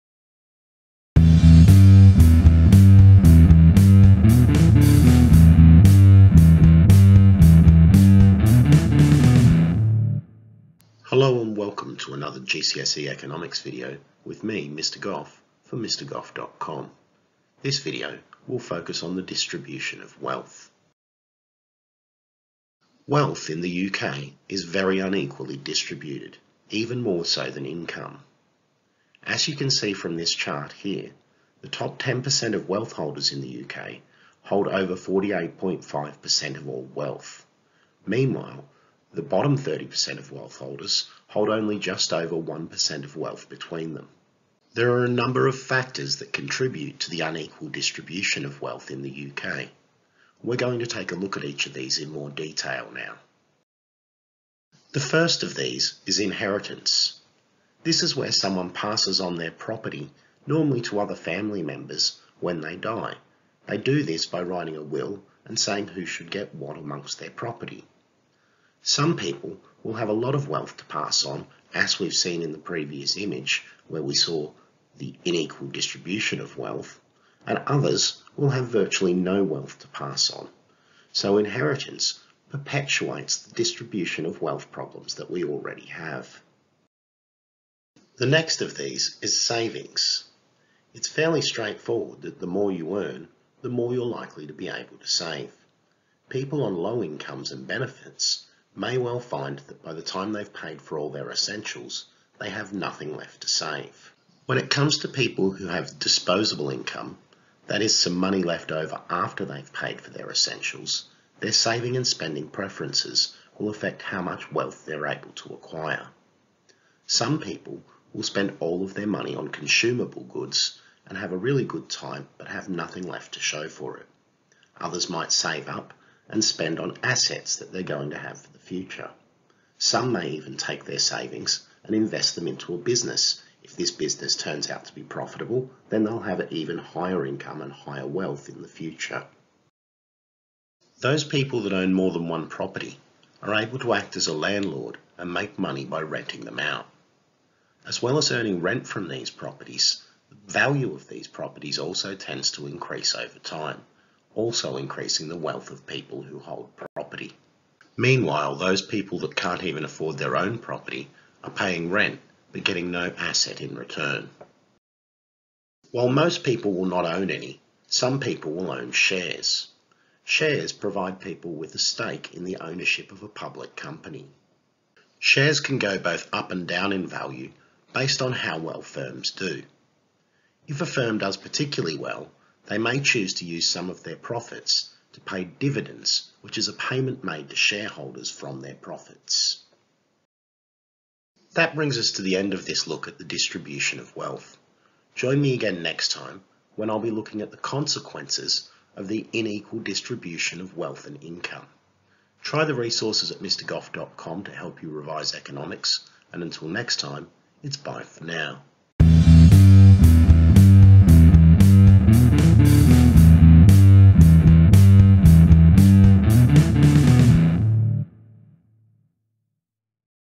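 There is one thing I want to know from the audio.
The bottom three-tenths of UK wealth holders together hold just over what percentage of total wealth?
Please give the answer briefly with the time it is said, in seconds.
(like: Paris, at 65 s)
1%, at 42 s.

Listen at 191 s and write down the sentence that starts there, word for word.
That brings us to the end of this look at the distribution of wealth.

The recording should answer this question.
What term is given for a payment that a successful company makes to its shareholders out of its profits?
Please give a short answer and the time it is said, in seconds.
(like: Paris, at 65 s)
dividends, at 185 s.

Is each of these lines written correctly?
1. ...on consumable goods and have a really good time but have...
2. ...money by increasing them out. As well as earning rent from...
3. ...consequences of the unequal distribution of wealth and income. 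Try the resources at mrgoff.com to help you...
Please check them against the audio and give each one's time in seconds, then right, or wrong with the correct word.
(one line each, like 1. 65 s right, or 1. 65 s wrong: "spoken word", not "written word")
1. 119 s right
2. 145 s wrong: "renting", not "increasing"
3. 197 s right.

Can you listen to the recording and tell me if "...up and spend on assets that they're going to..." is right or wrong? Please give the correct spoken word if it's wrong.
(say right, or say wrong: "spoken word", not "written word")
right.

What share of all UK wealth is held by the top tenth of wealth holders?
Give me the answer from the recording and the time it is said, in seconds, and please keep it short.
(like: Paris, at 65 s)
over 48.5%, at 34 s.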